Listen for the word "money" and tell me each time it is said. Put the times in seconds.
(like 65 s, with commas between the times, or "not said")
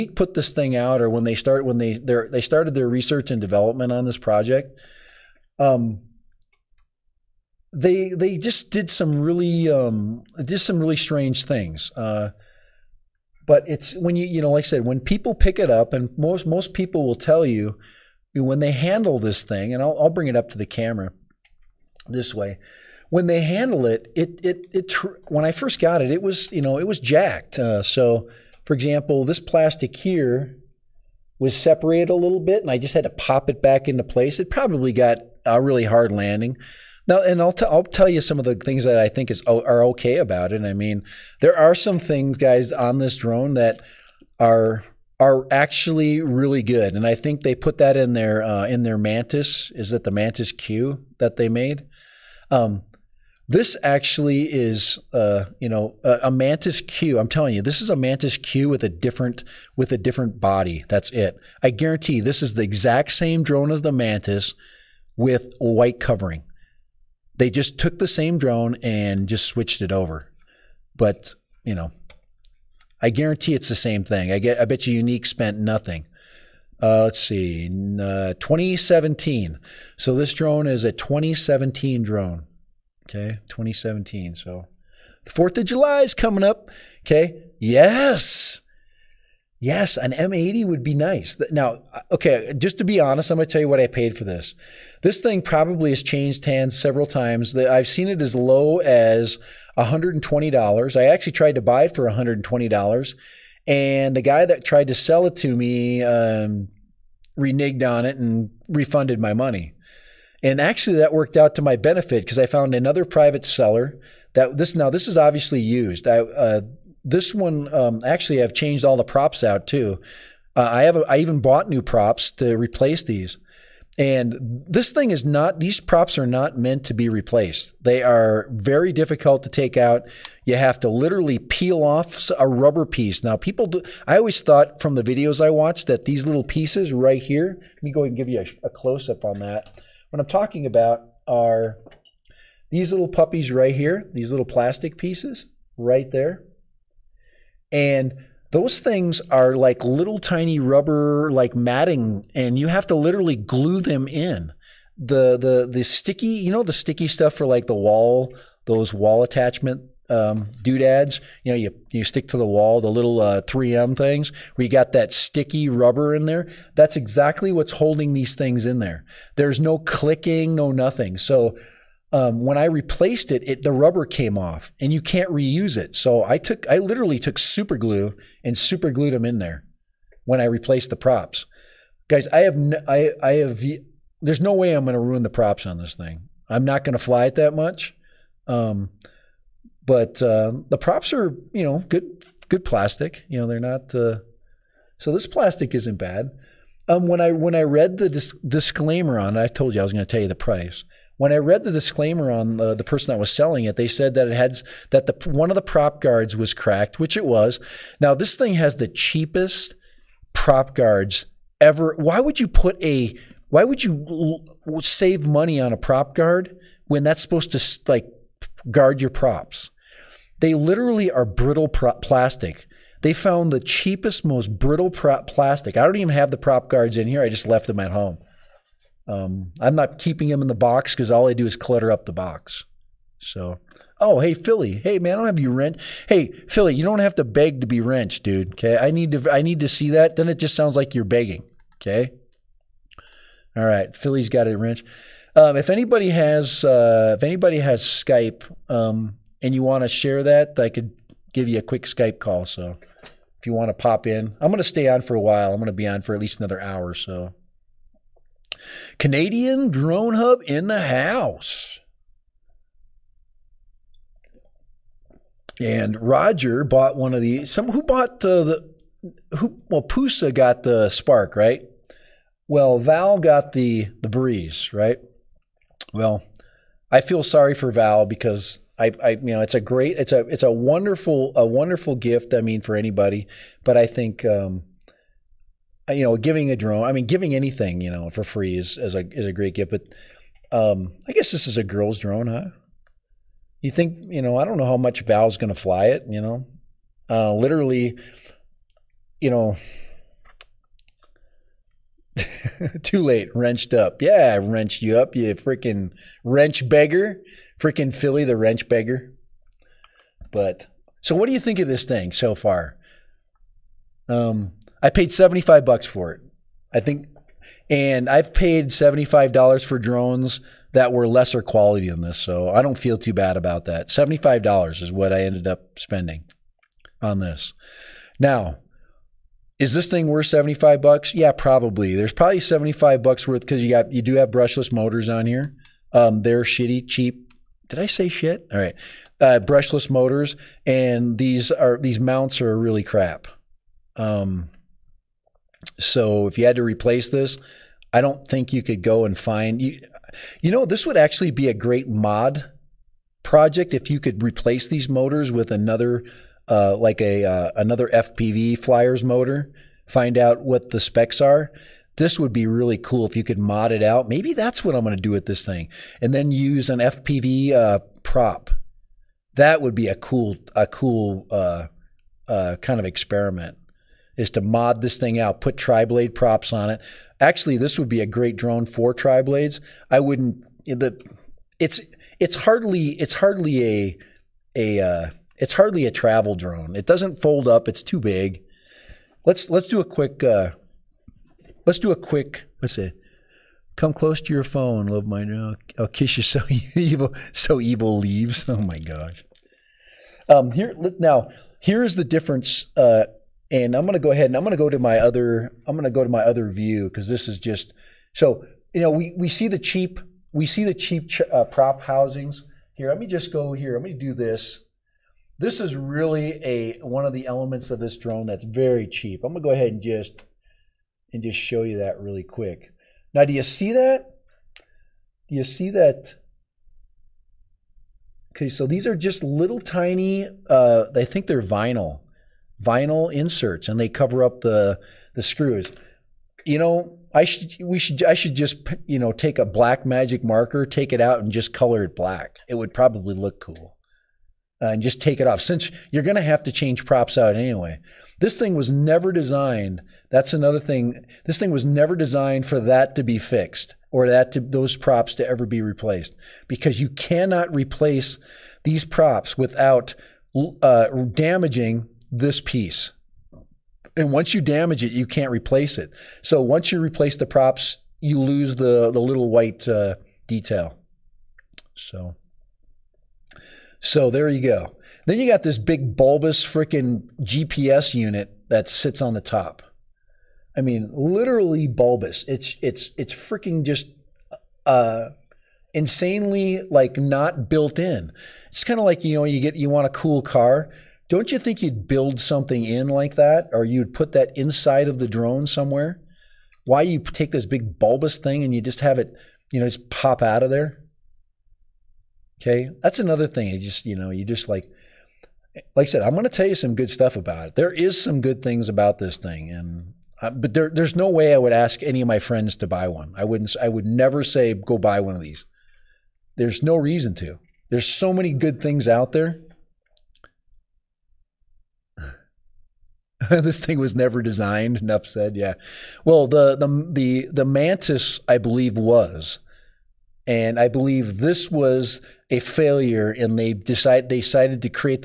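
109 s, 215 s.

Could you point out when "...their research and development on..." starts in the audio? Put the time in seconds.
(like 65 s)
2 s.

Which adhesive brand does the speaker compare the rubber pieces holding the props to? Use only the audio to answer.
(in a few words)
3M.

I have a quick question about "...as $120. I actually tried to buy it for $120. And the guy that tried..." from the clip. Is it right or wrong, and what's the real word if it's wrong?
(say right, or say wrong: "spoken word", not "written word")
right.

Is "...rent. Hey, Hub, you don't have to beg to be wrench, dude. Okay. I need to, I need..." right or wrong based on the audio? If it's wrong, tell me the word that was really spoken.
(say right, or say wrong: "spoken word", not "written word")
wrong: "Philly", not "Hub".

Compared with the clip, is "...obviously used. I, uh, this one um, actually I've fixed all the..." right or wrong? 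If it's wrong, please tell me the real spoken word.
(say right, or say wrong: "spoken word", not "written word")
wrong: "changed", not "fixed".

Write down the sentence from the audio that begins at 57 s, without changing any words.
I'm telling you, this is a mantis Q with a different with a different body.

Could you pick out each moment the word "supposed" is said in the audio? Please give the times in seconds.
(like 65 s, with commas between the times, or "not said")
217 s.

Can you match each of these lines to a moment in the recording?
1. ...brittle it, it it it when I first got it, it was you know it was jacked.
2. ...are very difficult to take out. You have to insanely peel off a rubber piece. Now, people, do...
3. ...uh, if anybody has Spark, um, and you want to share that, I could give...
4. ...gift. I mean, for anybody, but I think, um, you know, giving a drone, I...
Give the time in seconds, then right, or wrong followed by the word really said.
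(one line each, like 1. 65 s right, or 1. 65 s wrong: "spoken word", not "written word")
1. 23 s wrong: "handle", not "brittle"
2. 128 s wrong: "literally", not "insanely"
3. 246 s wrong: "Skype", not "Spark"
4. 281 s right.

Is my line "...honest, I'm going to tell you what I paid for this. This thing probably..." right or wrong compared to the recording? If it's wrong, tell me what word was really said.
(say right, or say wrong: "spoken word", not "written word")
right.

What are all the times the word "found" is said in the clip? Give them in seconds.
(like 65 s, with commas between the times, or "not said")
112 s, 223 s.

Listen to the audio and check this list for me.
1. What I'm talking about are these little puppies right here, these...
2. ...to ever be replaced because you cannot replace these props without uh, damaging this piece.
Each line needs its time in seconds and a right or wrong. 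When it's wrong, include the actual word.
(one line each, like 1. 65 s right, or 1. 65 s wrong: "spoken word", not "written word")
1. 140 s right
2. 455 s right.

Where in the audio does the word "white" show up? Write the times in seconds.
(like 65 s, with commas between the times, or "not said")
65 s, 469 s.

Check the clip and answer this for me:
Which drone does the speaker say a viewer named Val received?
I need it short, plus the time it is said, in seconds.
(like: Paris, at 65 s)
Breeze, at 274 s.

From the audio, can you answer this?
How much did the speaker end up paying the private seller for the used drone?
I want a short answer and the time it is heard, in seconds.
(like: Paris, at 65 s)
$75, at 315 s.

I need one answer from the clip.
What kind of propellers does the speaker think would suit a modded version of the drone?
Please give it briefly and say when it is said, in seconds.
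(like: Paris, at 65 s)
tri-blade props, at 375 s.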